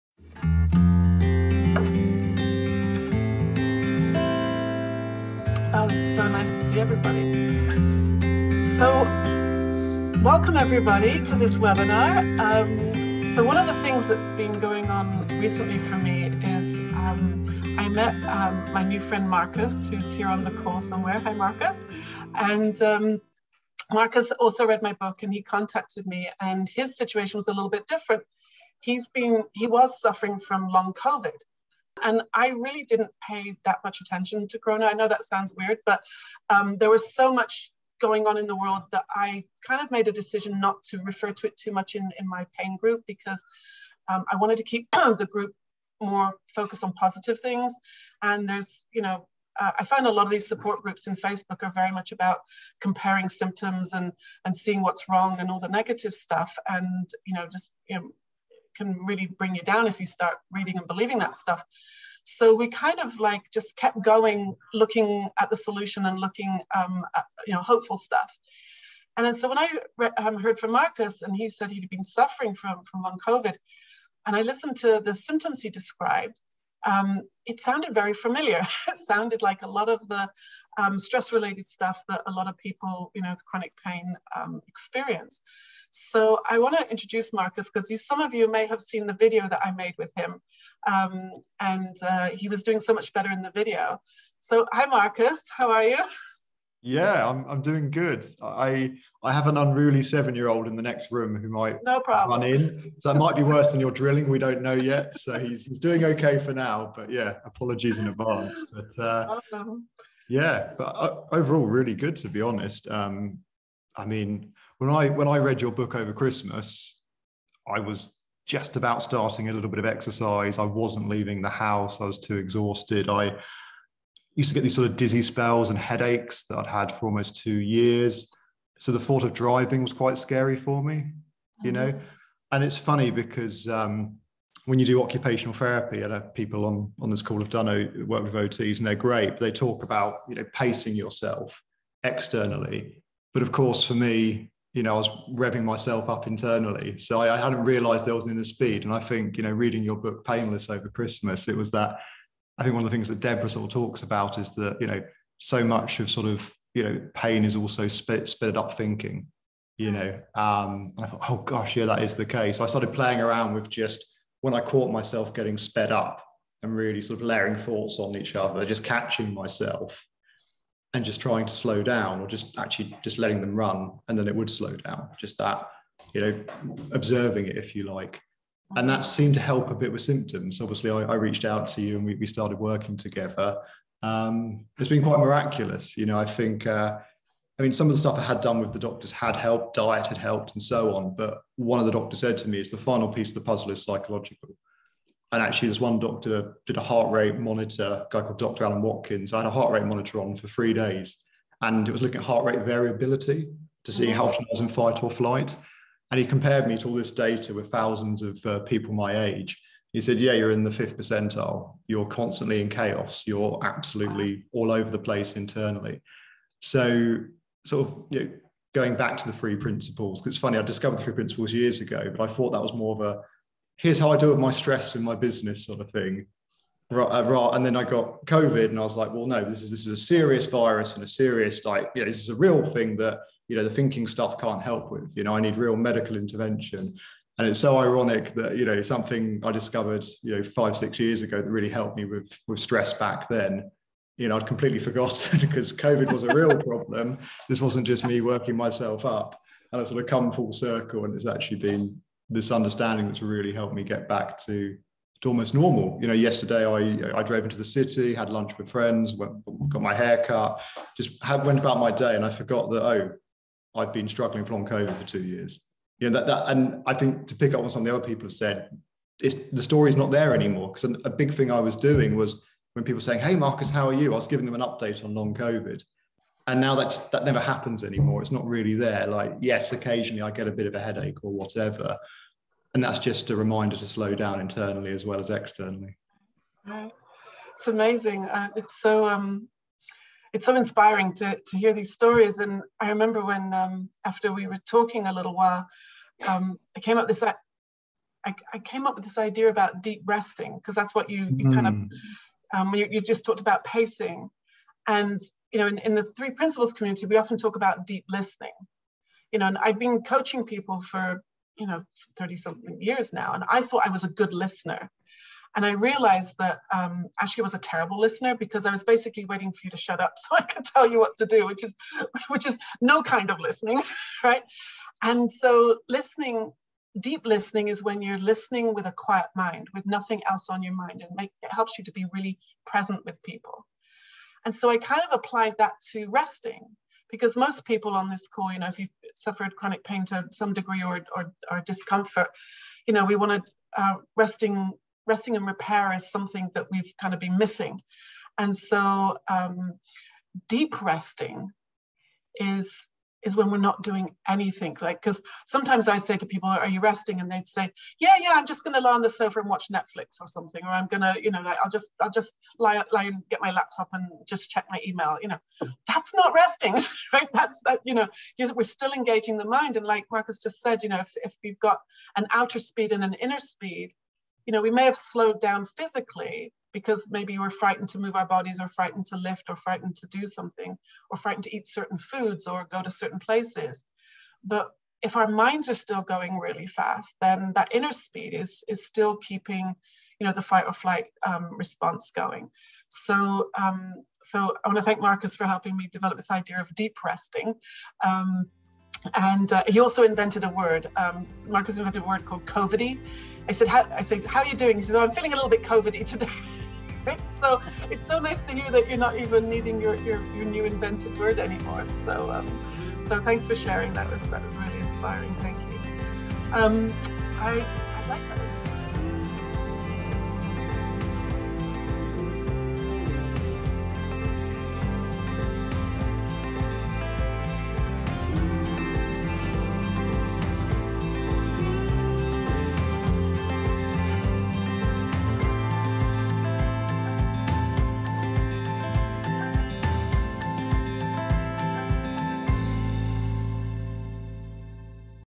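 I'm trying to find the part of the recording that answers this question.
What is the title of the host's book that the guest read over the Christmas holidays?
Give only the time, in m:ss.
2:30.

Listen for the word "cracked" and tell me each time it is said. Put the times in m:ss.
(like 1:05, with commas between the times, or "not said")
not said.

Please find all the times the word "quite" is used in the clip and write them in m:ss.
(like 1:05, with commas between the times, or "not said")
2:09, 3:05.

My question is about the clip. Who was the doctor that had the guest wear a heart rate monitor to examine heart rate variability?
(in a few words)
Dr. Alan Watkins.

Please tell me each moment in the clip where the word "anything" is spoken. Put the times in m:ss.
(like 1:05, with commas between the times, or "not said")
5:54.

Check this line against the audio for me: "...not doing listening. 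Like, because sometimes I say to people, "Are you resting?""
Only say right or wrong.
wrong.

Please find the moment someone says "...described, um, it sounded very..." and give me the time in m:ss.
1:15.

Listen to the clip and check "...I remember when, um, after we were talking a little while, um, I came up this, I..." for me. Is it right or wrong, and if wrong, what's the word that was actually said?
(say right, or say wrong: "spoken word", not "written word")
right.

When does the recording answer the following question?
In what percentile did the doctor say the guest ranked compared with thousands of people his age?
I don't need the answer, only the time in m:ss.
3:30.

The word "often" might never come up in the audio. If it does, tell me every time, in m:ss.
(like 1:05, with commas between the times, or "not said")
3:24, 5:07.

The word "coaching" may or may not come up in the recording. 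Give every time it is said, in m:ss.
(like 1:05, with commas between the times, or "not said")
5:10.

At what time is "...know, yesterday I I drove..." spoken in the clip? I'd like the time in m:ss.
4:16.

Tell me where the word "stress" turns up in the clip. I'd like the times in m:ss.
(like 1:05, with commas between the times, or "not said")
1:20, 3:44, 4:02.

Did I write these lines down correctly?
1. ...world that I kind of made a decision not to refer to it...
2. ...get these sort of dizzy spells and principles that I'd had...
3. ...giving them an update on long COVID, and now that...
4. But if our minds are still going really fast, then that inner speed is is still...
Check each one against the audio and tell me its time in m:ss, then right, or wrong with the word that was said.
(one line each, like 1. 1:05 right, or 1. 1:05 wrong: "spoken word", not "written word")
1. 0:38 right
2. 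2:04 wrong: "headaches", not "principles"
3. 4:34 right
4. 6:24 right.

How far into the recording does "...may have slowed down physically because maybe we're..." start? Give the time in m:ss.
6:14.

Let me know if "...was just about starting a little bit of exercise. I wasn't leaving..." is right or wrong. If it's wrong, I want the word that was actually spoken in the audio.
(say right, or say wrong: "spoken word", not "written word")
right.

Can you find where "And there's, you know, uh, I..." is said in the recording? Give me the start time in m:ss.
0:48.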